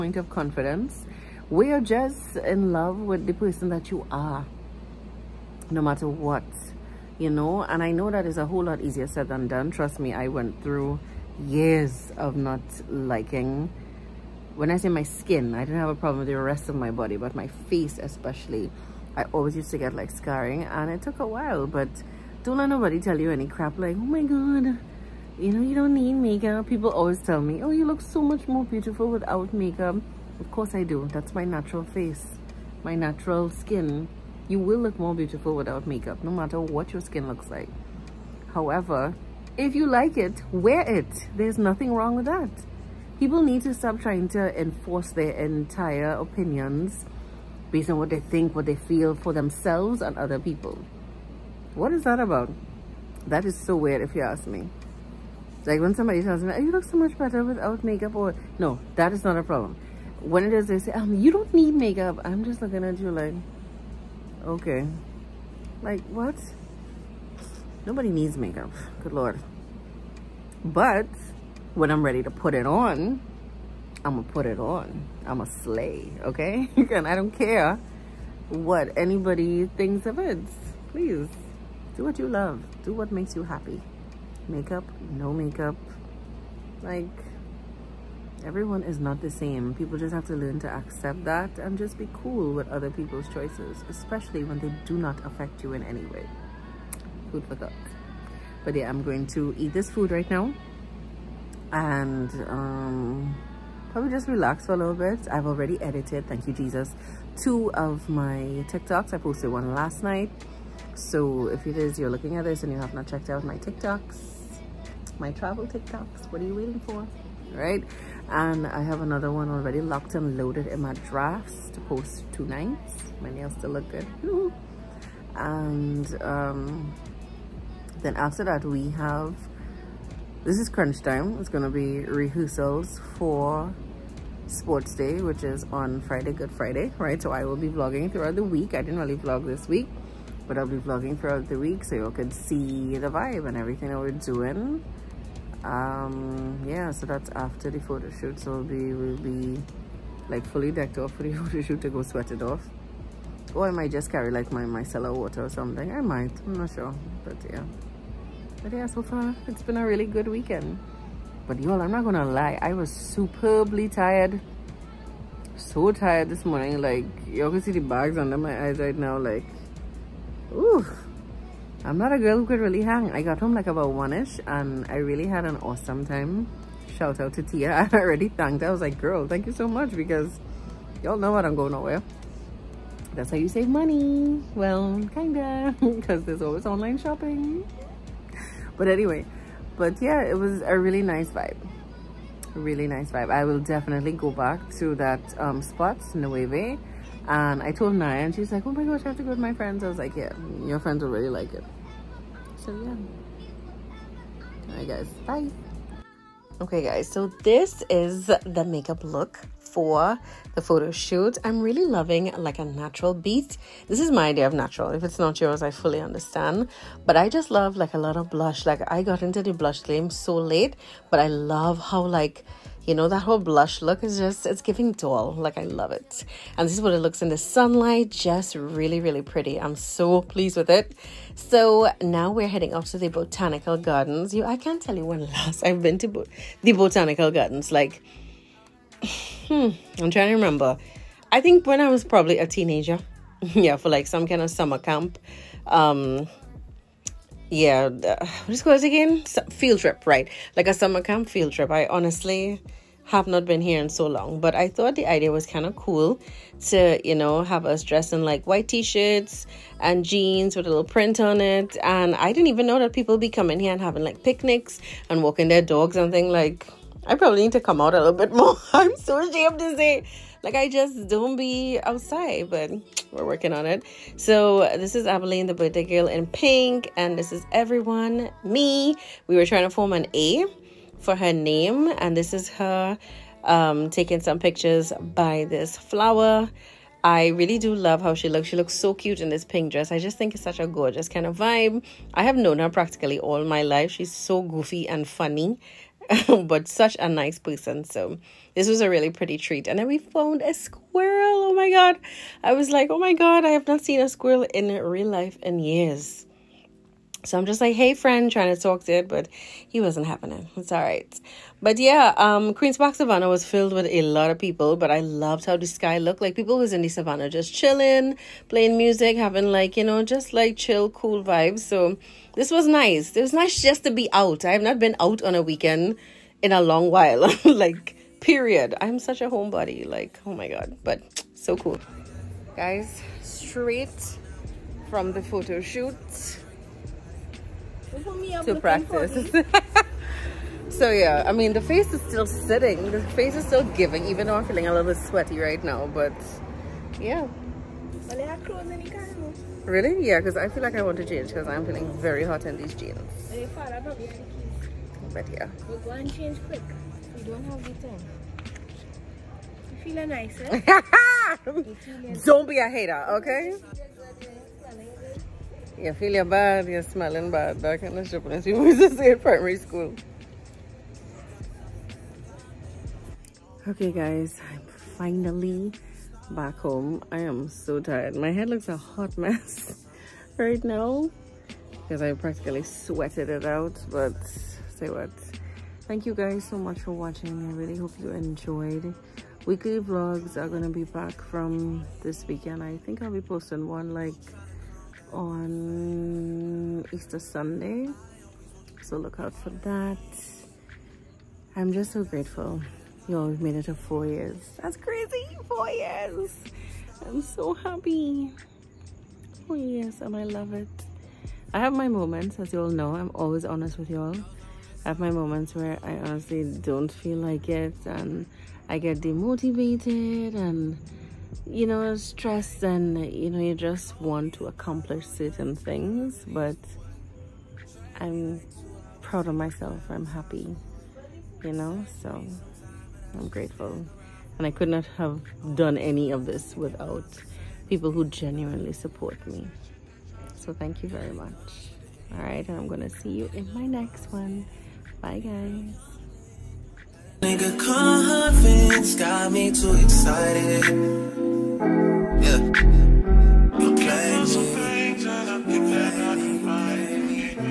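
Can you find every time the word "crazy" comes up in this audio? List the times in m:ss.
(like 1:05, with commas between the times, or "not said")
6:44.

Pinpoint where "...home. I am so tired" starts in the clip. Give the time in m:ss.
6:16.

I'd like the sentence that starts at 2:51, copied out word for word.
I'm not a girl who could really hang.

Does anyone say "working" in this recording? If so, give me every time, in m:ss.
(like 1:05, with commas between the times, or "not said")
4:33.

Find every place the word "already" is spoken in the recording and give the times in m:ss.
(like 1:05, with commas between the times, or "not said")
1:45, 1:59, 2:57.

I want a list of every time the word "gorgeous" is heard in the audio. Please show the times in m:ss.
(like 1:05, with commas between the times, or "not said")
4:50.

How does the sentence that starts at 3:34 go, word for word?
If it's not yours, I fully understand.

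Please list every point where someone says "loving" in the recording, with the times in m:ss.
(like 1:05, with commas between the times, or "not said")
3:31.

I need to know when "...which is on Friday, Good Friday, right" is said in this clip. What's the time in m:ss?
2:15.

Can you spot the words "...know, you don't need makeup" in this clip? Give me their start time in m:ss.
0:25.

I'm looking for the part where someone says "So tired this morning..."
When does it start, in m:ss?
2:45.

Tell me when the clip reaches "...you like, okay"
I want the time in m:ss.
1:02.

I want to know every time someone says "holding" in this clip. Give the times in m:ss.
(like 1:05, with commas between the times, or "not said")
not said.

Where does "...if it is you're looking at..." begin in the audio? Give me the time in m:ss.
1:51.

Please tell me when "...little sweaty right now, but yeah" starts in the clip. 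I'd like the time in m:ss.
5:44.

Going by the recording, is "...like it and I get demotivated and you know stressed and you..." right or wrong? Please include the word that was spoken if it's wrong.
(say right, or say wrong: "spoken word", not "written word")
right.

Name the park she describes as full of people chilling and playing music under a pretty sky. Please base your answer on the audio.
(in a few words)
Queen's Park Savannah.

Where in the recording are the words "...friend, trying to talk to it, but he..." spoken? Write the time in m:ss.
5:07.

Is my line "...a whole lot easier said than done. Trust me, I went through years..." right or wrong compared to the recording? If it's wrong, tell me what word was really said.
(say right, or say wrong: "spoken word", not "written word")
right.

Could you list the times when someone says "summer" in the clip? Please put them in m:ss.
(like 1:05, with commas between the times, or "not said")
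4:04, 4:10.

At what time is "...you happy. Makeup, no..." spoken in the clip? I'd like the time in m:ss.
1:23.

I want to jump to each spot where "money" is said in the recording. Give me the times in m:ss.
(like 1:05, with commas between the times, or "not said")
3:03.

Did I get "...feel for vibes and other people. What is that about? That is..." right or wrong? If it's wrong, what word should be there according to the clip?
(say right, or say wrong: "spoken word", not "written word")
wrong: "themselves", not "vibes".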